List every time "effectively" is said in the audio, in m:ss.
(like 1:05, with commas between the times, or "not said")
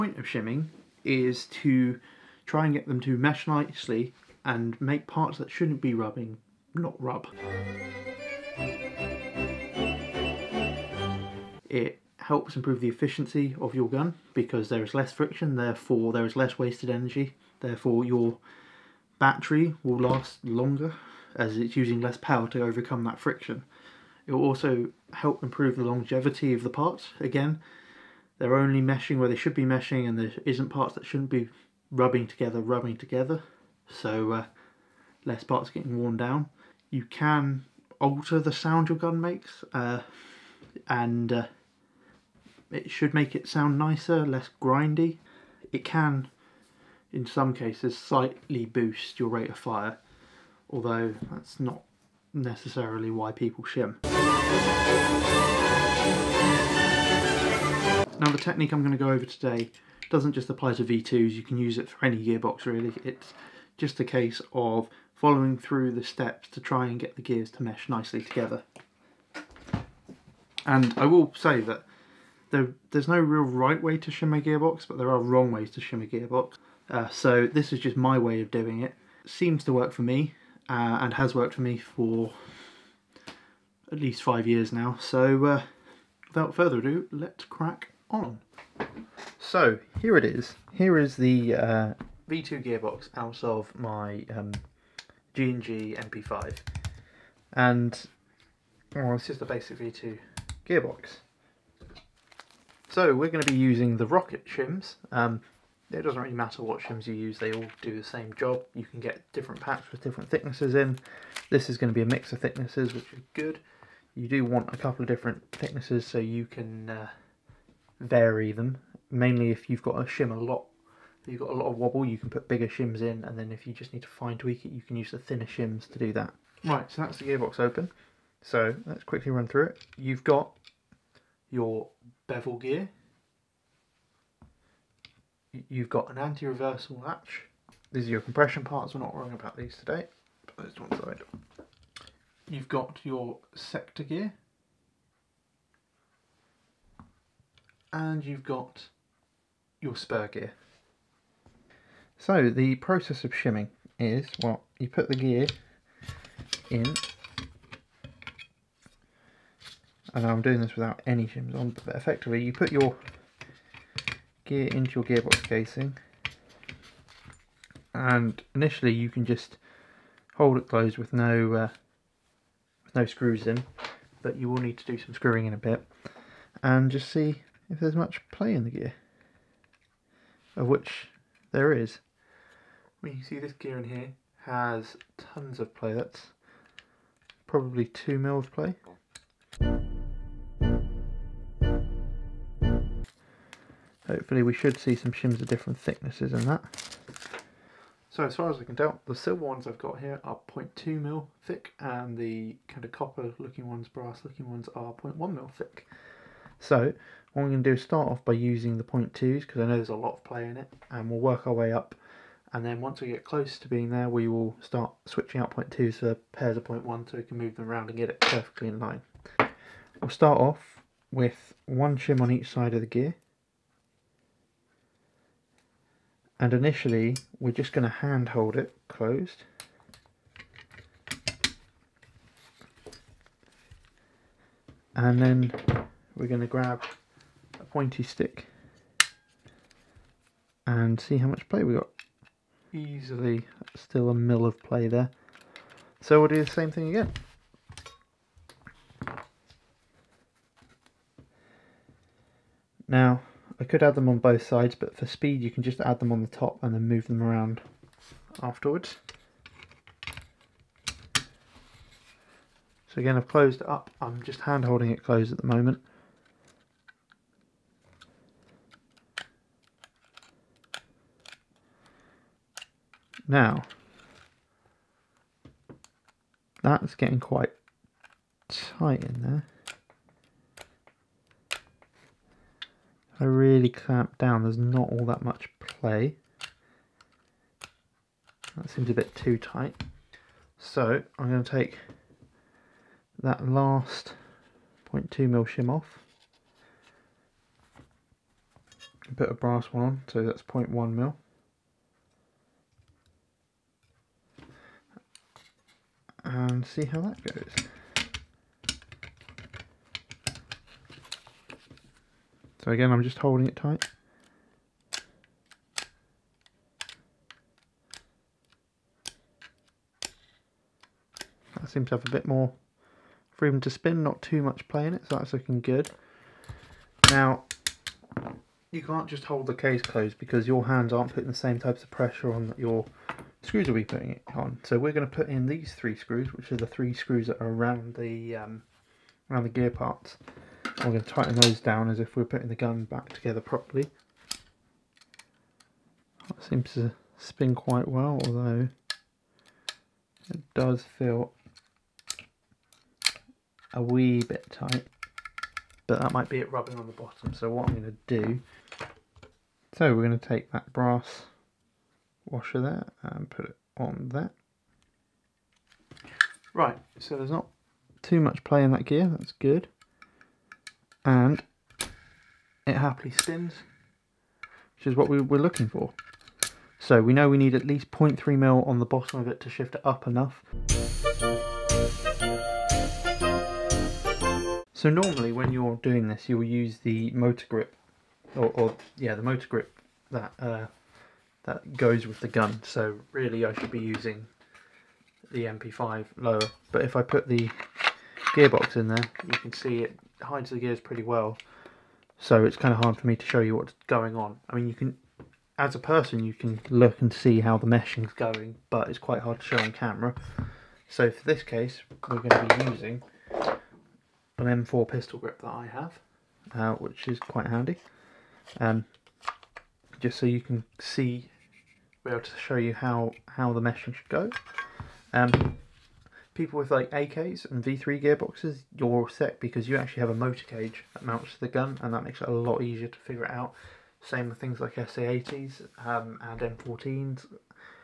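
2:41.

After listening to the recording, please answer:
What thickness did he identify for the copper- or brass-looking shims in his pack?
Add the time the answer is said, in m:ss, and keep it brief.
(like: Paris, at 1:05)
0.1 mm, at 3:24.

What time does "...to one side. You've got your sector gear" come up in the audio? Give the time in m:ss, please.
2:20.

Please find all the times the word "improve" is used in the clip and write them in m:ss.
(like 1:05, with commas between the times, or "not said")
0:12, 0:25.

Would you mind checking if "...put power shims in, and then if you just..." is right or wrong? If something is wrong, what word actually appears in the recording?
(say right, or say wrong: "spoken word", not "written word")
wrong: "bigger", not "power".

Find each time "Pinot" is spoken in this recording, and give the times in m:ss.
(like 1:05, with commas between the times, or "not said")
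not said.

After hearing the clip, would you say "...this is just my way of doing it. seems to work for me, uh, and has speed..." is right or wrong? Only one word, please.
wrong.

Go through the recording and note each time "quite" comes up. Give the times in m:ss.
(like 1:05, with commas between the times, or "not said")
4:37, 5:47, 6:48, 6:57.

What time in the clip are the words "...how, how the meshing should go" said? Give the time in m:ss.
7:02.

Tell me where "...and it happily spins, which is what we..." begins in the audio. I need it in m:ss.
6:11.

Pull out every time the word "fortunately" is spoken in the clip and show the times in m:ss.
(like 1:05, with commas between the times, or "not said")
not said.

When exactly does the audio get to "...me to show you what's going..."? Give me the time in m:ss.
6:43.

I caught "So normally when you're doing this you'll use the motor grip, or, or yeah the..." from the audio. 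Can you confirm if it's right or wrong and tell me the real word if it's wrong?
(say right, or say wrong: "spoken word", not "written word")
right.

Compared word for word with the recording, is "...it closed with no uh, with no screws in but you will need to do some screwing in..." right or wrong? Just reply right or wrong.
right.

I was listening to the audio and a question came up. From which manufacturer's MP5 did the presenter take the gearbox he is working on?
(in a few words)
G&G.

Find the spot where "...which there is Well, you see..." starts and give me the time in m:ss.
3:00.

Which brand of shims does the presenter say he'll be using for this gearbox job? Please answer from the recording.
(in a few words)
Rocket.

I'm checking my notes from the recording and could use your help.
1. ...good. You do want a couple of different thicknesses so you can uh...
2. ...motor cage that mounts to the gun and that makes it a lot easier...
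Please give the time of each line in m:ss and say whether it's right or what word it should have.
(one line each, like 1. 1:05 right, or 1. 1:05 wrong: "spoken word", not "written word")
1. 1:53 right
2. 7:10 right.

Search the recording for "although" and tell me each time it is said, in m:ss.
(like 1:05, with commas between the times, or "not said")
0:50, 5:48.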